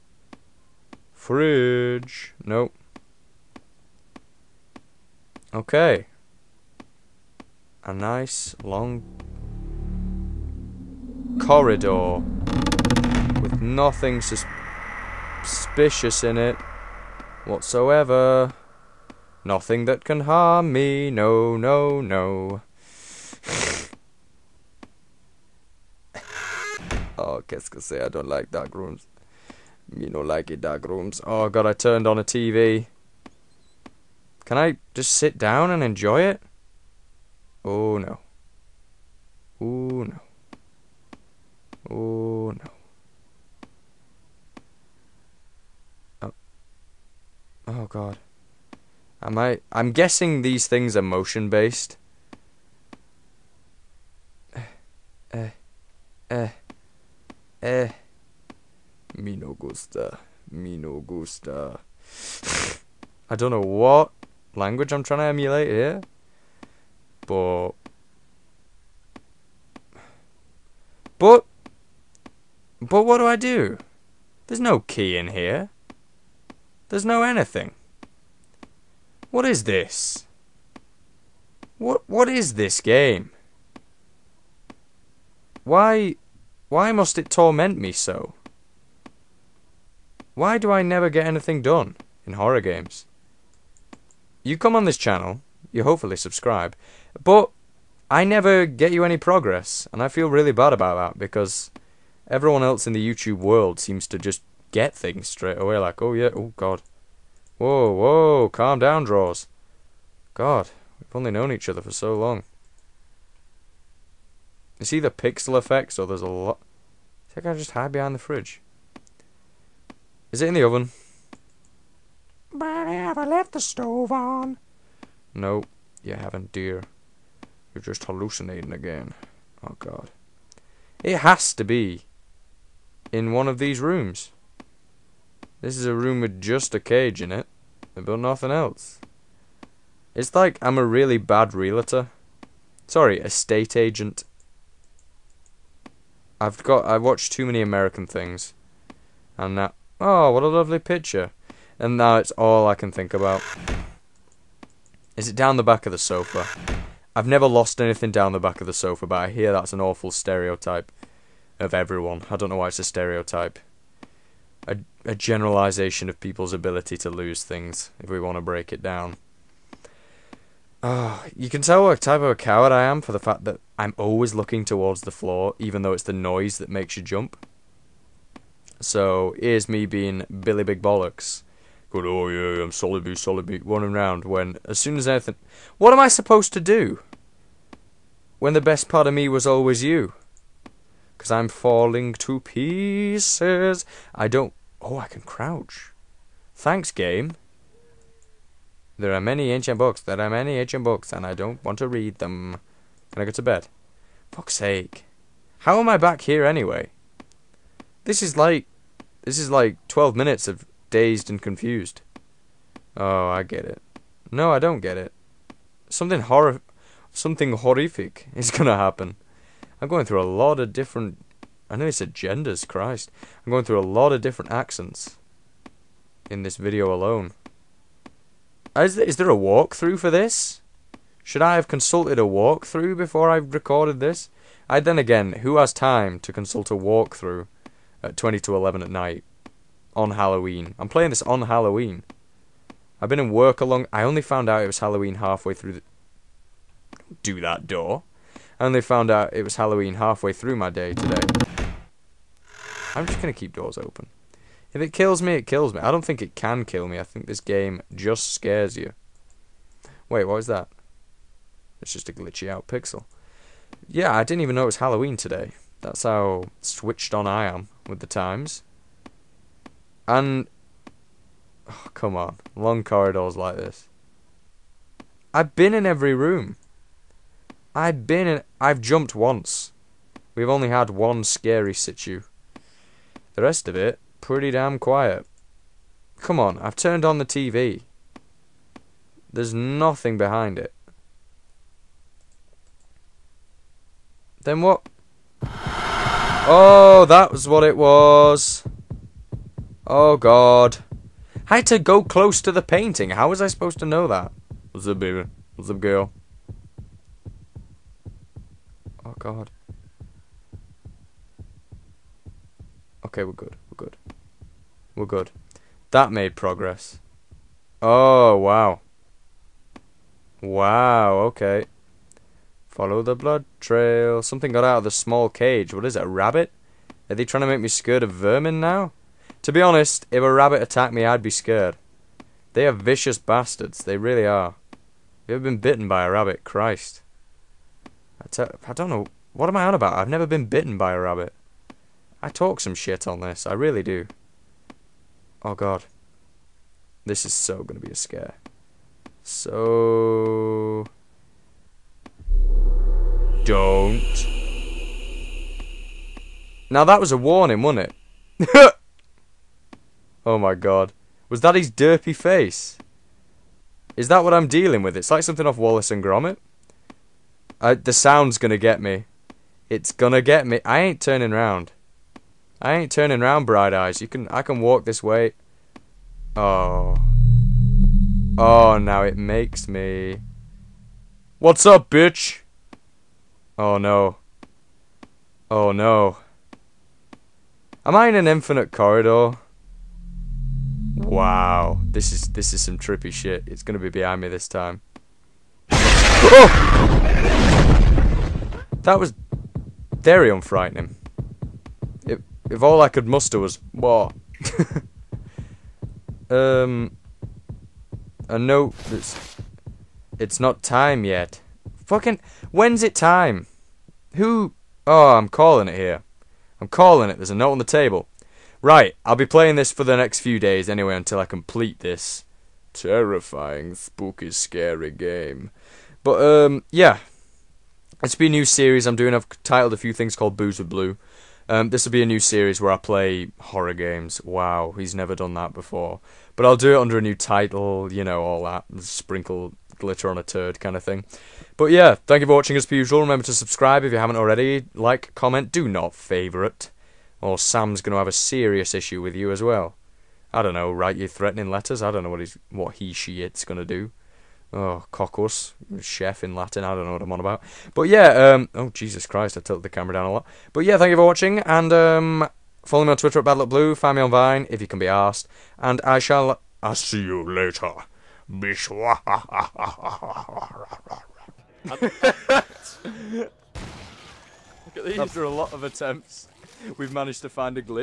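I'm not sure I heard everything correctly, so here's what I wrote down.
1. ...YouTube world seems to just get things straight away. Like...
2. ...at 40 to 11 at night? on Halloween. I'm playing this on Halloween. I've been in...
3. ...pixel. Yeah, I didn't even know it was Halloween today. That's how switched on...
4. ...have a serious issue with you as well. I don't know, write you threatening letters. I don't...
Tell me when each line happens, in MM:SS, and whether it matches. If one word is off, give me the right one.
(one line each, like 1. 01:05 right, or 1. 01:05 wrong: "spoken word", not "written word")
1. 01:43 right
2. 03:58 wrong: "20", not "40"
3. 04:22 right
4. 07:27 right.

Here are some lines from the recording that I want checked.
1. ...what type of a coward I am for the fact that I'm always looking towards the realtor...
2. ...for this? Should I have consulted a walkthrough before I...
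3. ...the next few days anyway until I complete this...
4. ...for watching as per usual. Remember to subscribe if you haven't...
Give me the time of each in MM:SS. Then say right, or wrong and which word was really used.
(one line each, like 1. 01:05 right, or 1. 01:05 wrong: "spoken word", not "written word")
1. 02:51 wrong: "floor", not "realtor"
2. 03:49 right
3. 06:59 right
4. 07:22 right.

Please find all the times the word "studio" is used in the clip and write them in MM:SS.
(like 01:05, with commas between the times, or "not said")
not said.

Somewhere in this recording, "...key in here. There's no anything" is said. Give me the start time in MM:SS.
01:14.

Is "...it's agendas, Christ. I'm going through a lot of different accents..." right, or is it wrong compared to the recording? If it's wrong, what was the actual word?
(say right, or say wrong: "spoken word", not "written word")
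right.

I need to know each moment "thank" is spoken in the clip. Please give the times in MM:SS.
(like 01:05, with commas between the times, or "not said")
03:16, 07:22, 07:40.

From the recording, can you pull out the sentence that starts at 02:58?
So, here's me being Billy Big Bollocks Good, oh yeah, I'm solid B, solid B.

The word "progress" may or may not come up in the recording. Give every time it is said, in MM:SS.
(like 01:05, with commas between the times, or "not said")
01:39, 05:16.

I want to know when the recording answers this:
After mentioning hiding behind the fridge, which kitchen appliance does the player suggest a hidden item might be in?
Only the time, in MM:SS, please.
02:00.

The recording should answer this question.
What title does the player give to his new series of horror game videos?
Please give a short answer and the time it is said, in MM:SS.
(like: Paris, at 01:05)
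Boos with Blue, at 07:10.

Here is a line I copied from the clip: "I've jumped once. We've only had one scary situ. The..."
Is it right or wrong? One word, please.
right.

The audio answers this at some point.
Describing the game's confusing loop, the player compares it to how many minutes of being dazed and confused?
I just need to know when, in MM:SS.
03:29.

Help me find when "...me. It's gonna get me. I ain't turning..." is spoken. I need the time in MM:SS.
06:08.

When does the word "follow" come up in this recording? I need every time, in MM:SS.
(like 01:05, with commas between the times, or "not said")
05:22, 07:42.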